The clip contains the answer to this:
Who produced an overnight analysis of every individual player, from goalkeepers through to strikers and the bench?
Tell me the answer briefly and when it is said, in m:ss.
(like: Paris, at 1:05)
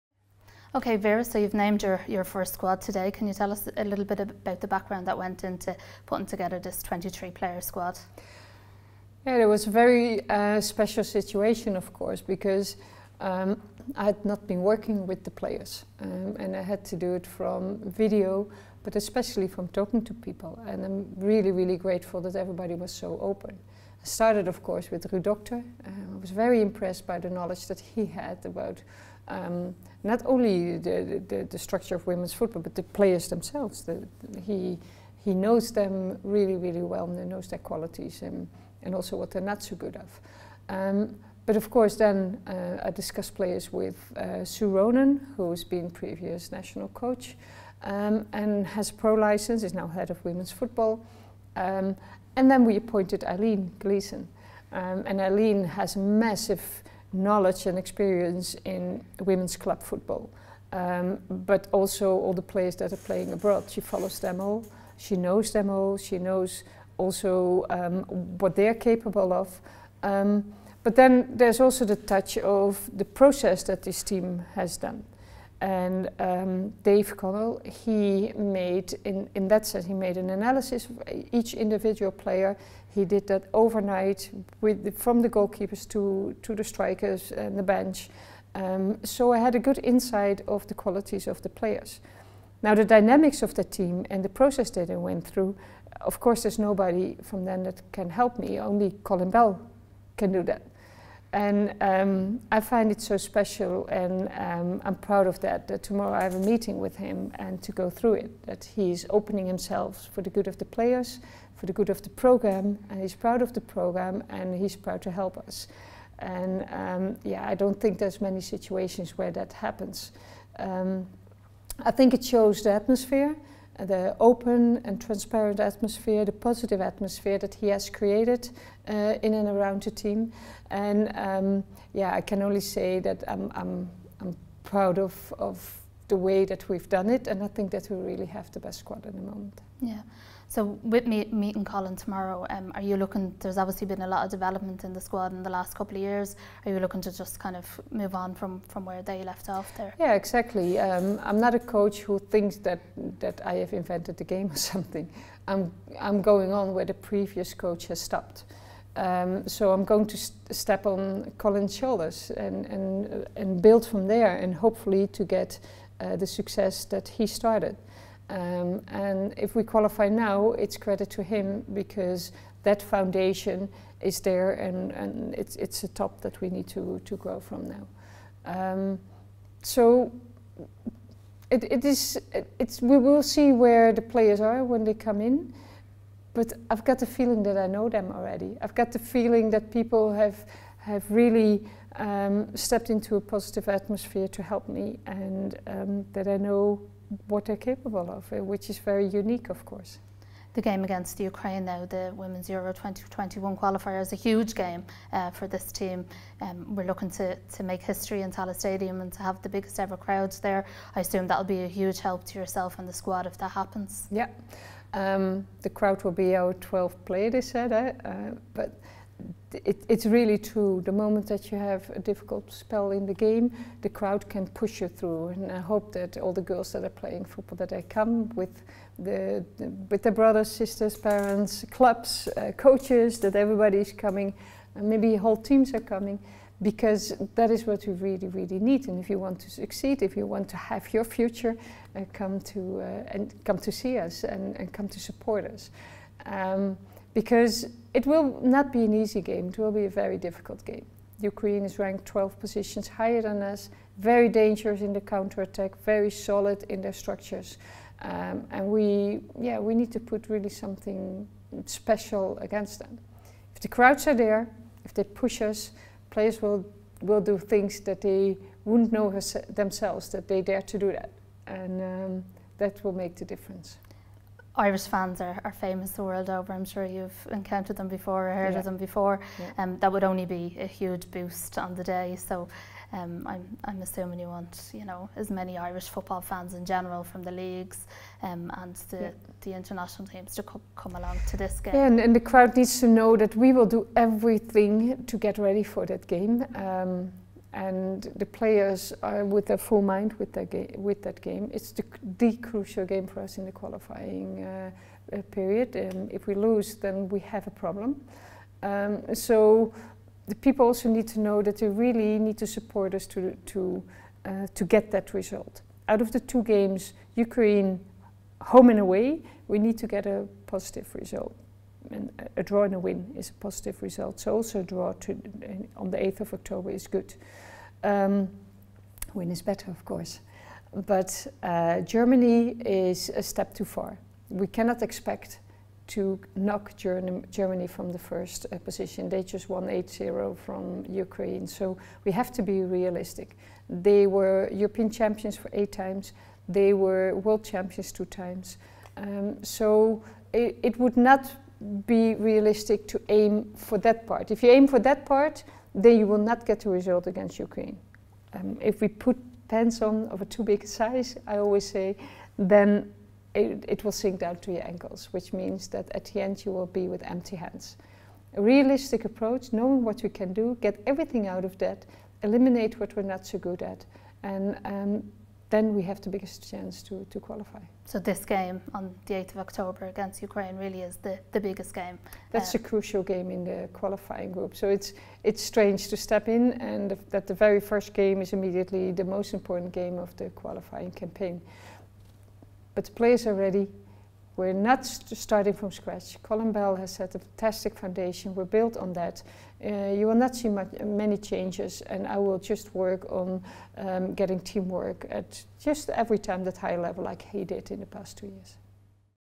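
Dave Connell, at 1:16.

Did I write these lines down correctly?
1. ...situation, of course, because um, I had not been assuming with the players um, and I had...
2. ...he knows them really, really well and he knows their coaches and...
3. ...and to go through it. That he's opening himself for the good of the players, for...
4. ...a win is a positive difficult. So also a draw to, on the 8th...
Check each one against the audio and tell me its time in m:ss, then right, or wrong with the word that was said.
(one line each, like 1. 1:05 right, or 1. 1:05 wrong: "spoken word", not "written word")
1. 0:11 wrong: "working", not "assuming"
2. 0:35 wrong: "qualities", not "coaches"
3. 1:47 right
4. 5:22 wrong: "result", not "difficult".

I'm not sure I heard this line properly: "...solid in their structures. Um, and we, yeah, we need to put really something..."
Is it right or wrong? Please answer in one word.
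right.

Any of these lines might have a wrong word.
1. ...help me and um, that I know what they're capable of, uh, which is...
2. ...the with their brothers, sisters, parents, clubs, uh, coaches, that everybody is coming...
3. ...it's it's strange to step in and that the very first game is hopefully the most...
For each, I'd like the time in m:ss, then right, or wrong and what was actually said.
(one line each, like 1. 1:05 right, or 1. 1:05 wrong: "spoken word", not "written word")
1. 3:14 right
2. 3:49 right
3. 6:24 wrong: "immediately", not "hopefully".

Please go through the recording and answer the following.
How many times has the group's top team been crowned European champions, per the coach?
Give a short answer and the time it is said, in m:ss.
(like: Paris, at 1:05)
8, at 5:45.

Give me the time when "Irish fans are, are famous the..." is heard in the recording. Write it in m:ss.
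4:34.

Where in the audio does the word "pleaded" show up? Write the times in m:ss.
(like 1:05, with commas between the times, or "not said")
not said.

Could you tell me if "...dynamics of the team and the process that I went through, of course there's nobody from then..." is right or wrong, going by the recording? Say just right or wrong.
right.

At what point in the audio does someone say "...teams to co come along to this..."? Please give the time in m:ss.
4:50.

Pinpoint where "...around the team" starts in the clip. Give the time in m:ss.
2:09.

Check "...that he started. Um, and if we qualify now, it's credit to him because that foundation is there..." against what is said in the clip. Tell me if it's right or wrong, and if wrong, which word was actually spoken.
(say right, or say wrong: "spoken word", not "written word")
right.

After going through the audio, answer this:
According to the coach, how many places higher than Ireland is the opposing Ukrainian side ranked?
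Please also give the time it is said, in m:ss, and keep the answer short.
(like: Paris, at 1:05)
12, at 4:12.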